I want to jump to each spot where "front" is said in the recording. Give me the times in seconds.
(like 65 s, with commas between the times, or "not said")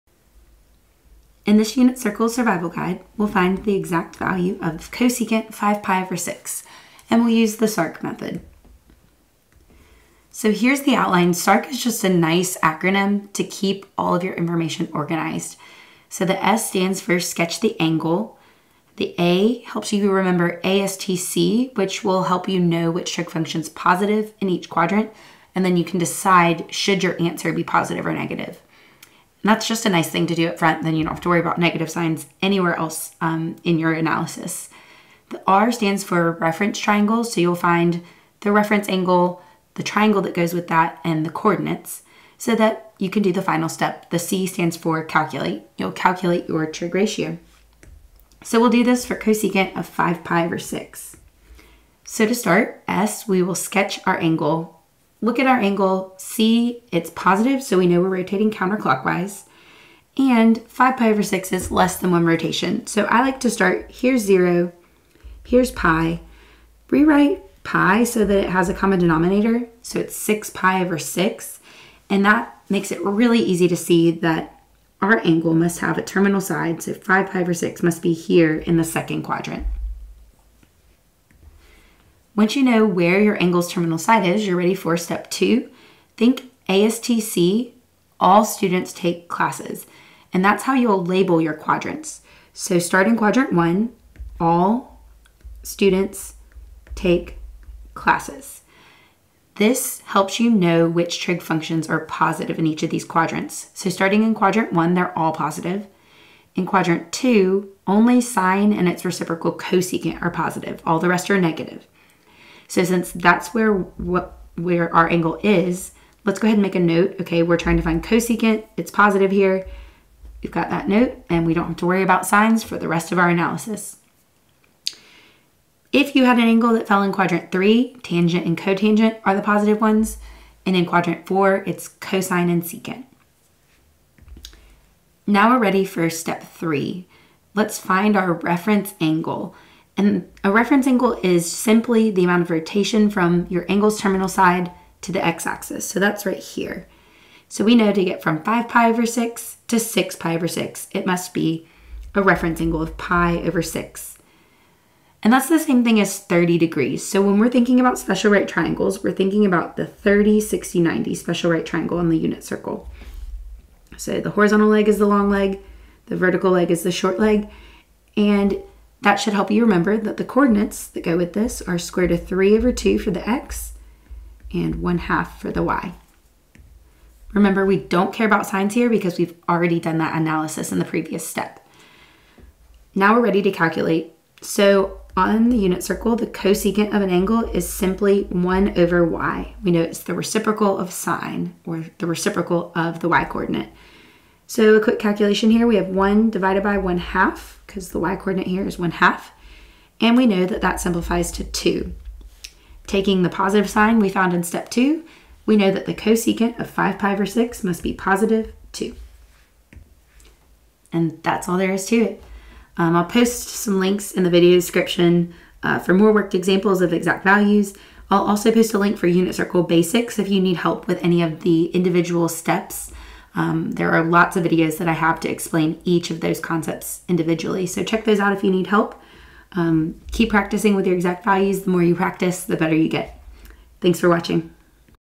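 30 s.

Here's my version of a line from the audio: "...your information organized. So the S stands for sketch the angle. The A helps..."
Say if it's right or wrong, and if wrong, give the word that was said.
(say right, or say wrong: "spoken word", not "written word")
right.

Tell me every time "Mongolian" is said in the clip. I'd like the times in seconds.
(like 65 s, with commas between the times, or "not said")
not said.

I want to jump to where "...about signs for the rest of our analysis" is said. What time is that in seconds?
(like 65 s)
122 s.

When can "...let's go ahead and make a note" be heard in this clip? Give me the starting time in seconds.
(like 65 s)
116 s.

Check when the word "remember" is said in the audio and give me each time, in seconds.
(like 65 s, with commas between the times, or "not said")
20 s, 169 s, 177 s.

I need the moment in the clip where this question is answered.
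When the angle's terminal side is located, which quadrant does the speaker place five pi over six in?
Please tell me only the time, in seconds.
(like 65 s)
78 s.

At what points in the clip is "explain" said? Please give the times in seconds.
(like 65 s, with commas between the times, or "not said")
225 s.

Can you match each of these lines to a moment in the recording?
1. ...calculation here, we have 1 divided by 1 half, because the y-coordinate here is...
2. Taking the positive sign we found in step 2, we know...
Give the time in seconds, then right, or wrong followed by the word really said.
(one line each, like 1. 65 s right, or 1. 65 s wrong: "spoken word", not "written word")
1. 194 s right
2. 202 s right.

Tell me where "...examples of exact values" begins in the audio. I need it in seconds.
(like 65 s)
216 s.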